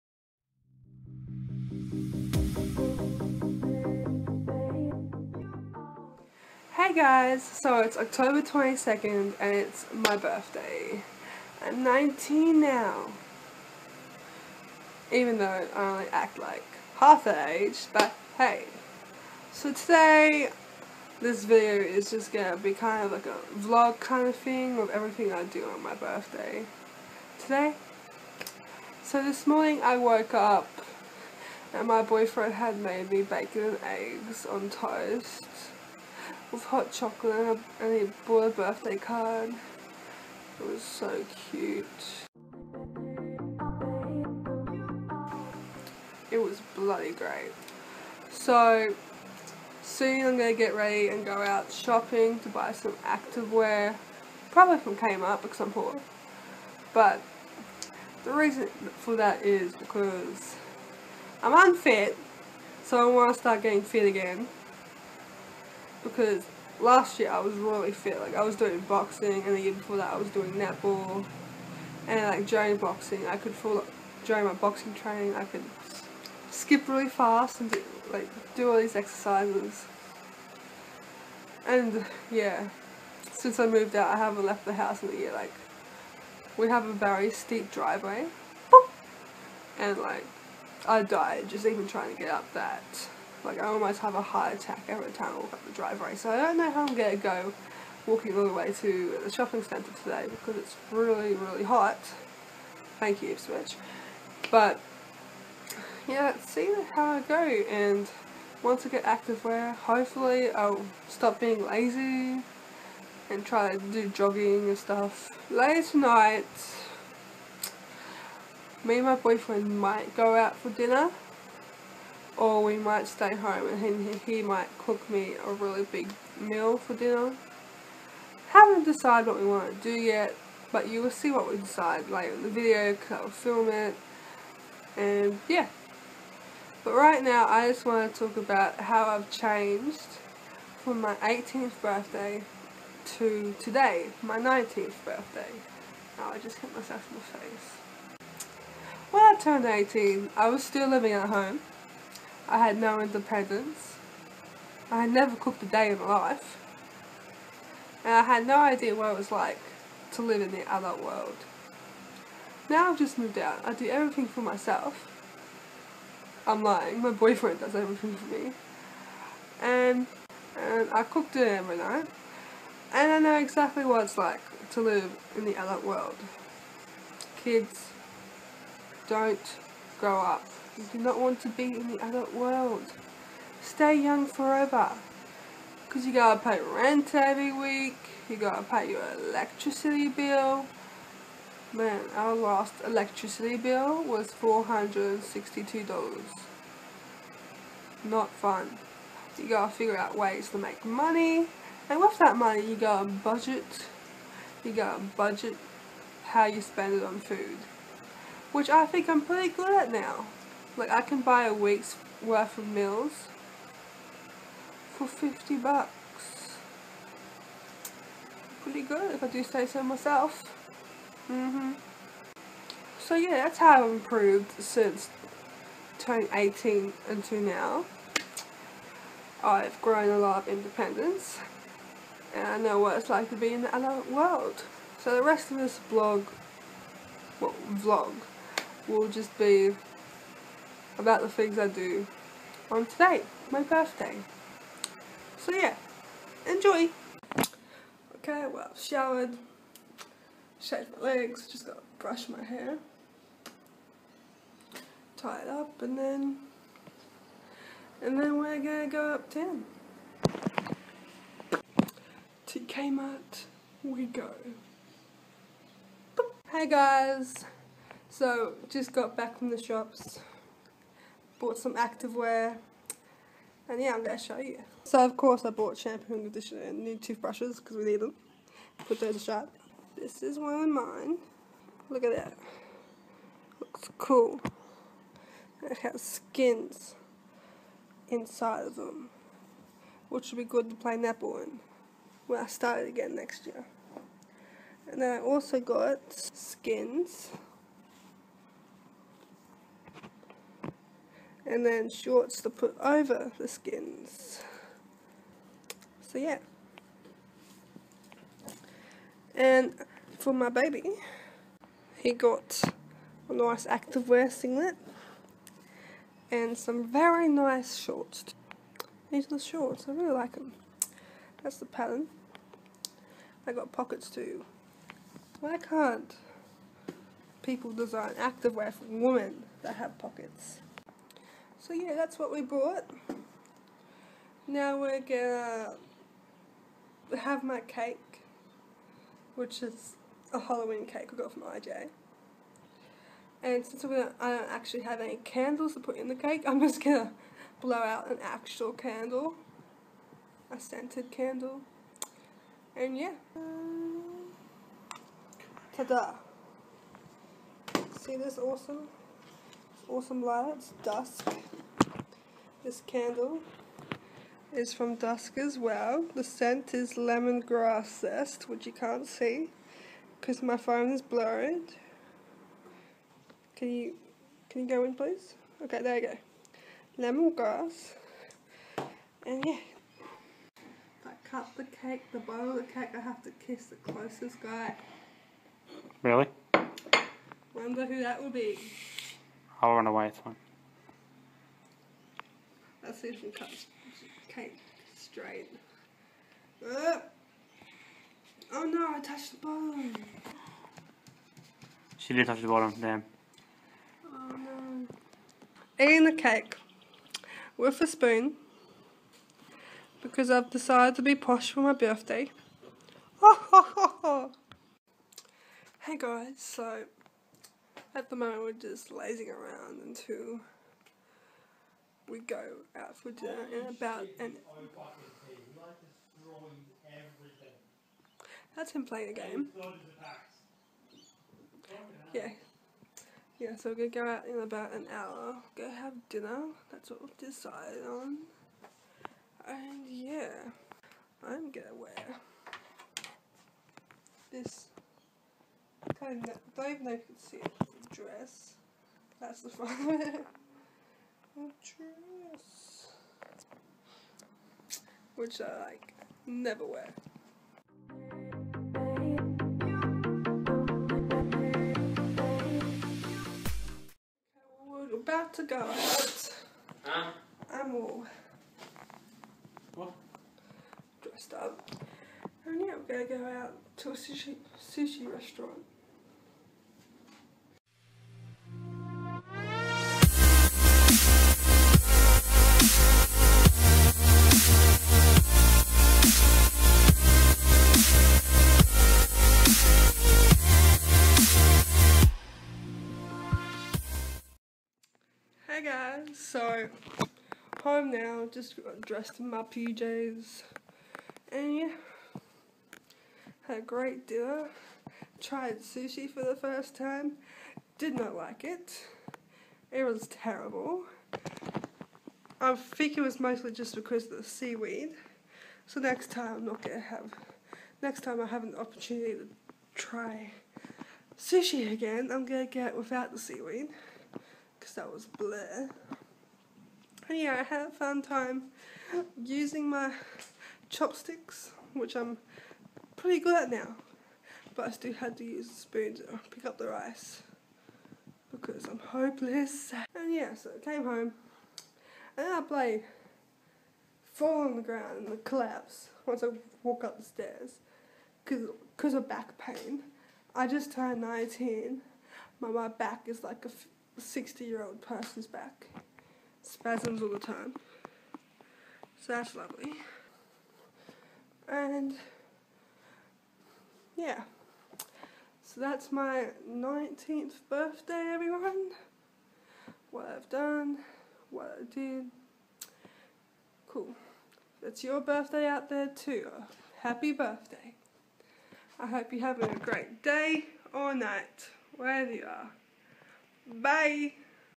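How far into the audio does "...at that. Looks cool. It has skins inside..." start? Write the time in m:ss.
4:42.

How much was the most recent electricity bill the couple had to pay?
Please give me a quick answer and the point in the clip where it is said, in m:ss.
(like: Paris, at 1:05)
$462, at 3:14.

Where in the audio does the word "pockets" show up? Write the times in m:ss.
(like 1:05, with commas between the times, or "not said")
5:23, 5:29.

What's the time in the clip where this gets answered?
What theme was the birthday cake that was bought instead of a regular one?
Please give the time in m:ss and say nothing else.
5:40.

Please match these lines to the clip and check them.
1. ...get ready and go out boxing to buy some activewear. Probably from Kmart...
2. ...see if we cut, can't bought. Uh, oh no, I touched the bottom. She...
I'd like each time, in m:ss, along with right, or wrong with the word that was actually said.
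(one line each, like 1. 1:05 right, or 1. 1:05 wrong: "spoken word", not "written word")
1. 0:50 wrong: "shopping", not "boxing"
2. 6:33 wrong: "straight", not "bought".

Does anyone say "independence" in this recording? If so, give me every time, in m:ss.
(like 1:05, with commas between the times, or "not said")
2:32, 3:50.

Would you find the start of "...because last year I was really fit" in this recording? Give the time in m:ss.
1:06.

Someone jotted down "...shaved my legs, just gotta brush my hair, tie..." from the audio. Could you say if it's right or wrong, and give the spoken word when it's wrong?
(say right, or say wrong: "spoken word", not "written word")
right.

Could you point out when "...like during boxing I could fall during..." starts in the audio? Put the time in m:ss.
1:12.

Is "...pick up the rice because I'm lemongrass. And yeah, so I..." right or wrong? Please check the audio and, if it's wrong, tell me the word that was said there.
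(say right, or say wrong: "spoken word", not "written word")
wrong: "hopeless", not "lemongrass".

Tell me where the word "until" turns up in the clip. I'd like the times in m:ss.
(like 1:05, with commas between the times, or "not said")
3:47, 6:59.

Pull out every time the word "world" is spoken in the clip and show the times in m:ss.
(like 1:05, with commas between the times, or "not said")
2:41, 2:55, 3:02, 3:54.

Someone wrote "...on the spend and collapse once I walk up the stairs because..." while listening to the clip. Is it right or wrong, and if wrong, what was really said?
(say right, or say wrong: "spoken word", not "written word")
wrong: "ground", not "spend".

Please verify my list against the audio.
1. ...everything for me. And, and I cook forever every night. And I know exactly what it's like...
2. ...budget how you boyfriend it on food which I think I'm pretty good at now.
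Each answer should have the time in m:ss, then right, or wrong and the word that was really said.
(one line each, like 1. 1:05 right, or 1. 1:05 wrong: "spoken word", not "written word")
1. 2:47 wrong: "dinner", not "forever"
2. 3:25 wrong: "spend", not "boyfriend".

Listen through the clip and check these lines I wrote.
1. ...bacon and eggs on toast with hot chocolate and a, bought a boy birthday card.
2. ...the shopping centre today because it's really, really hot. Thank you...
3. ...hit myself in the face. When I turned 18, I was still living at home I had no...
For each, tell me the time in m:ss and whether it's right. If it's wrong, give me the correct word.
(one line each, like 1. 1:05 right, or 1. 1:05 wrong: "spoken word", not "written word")
1. 0:33 right
2. 1:39 right
3. 2:26 right.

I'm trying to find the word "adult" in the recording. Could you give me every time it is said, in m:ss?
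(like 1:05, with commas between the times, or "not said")
2:40, 2:55, 3:02.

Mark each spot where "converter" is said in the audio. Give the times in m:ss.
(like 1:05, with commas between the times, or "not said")
not said.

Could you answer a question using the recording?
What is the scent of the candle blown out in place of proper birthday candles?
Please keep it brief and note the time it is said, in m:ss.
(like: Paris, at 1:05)
lemongrass zest, at 6:06.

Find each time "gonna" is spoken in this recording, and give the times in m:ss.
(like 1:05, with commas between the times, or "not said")
0:22, 4:18, 5:34, 5:46, 7:53, 8:36, 8:42.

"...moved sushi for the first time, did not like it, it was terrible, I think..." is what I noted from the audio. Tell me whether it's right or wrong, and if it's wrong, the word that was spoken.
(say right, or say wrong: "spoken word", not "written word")
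wrong: "tried", not "moved".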